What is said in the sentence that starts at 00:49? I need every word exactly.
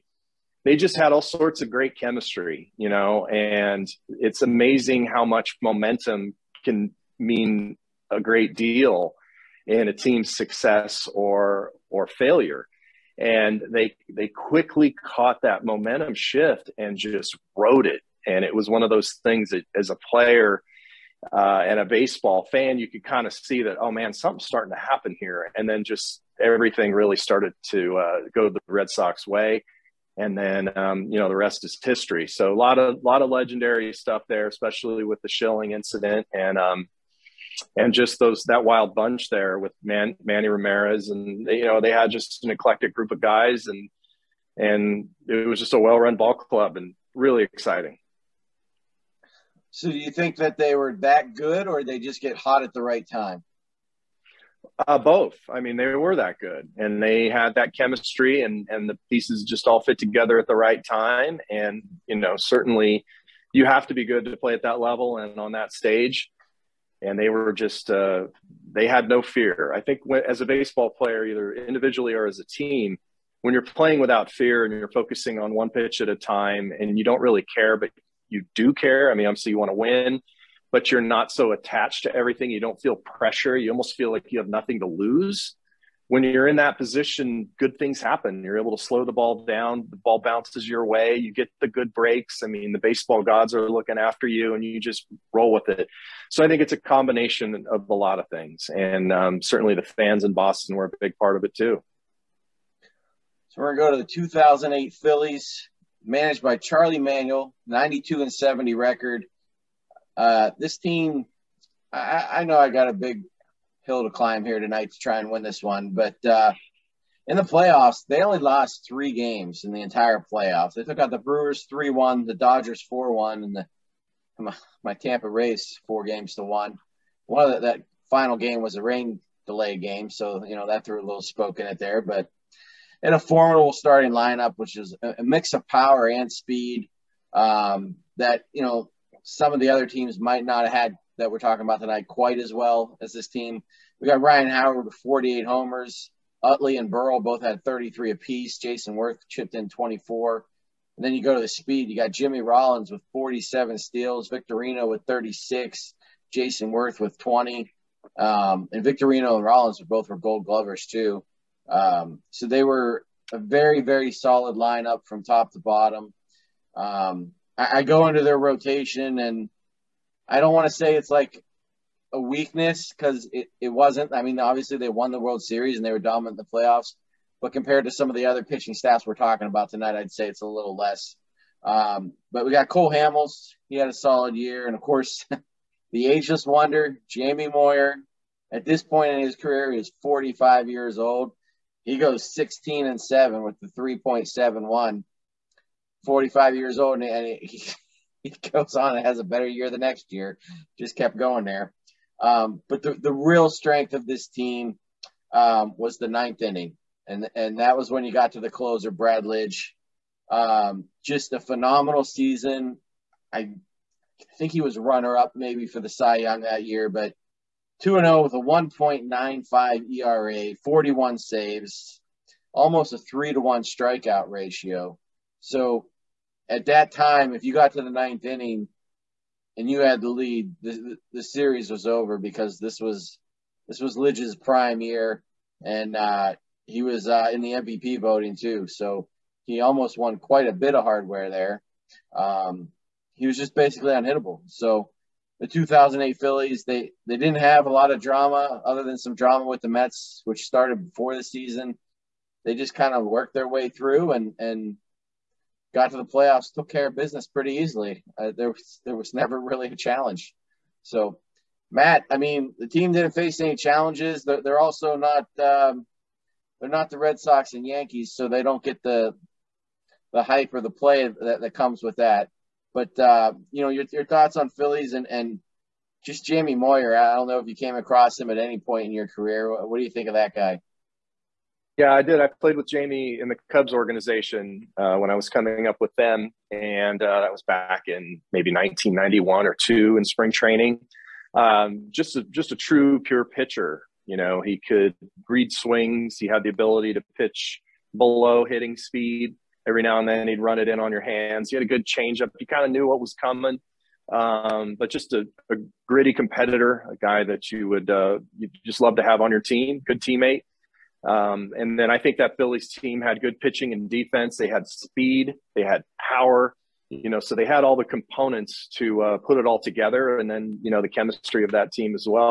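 So, do you think that they were that good, or they just get hot at the right time?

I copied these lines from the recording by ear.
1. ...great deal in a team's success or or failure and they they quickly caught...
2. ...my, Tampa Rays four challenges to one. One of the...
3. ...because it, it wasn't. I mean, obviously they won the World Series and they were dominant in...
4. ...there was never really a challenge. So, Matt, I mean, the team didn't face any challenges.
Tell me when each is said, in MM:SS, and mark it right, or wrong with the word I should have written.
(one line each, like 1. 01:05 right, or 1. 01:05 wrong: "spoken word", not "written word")
1. 00:08 right
2. 02:04 wrong: "games", not "challenges"
3. 02:52 right
4. 04:18 right.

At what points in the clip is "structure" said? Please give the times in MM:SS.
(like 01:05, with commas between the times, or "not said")
not said.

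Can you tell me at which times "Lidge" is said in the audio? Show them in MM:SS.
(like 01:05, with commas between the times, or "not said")
03:29, 03:53.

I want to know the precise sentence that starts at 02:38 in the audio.
Um, and Victorino and Rollins were both were gold glovers too.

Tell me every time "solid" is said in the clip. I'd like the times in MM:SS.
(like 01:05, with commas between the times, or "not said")
02:44, 03:03.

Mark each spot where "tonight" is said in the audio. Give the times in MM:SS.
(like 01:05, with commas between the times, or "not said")
01:54, 02:21, 02:59.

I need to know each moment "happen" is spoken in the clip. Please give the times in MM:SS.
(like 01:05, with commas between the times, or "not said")
00:24, 01:27.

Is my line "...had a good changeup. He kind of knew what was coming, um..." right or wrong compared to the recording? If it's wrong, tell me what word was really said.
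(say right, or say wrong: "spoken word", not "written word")
right.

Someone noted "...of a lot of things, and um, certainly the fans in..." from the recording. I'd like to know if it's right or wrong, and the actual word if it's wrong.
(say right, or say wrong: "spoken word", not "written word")
right.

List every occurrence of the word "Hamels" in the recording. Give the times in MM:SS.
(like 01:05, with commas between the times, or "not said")
03:02.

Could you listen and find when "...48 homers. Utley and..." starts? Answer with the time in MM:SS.
02:24.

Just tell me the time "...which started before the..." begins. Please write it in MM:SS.
04:10.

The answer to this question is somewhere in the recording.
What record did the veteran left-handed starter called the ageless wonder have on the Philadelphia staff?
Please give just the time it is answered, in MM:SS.
03:12.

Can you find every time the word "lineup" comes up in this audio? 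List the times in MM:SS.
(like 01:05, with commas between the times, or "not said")
02:14, 02:44.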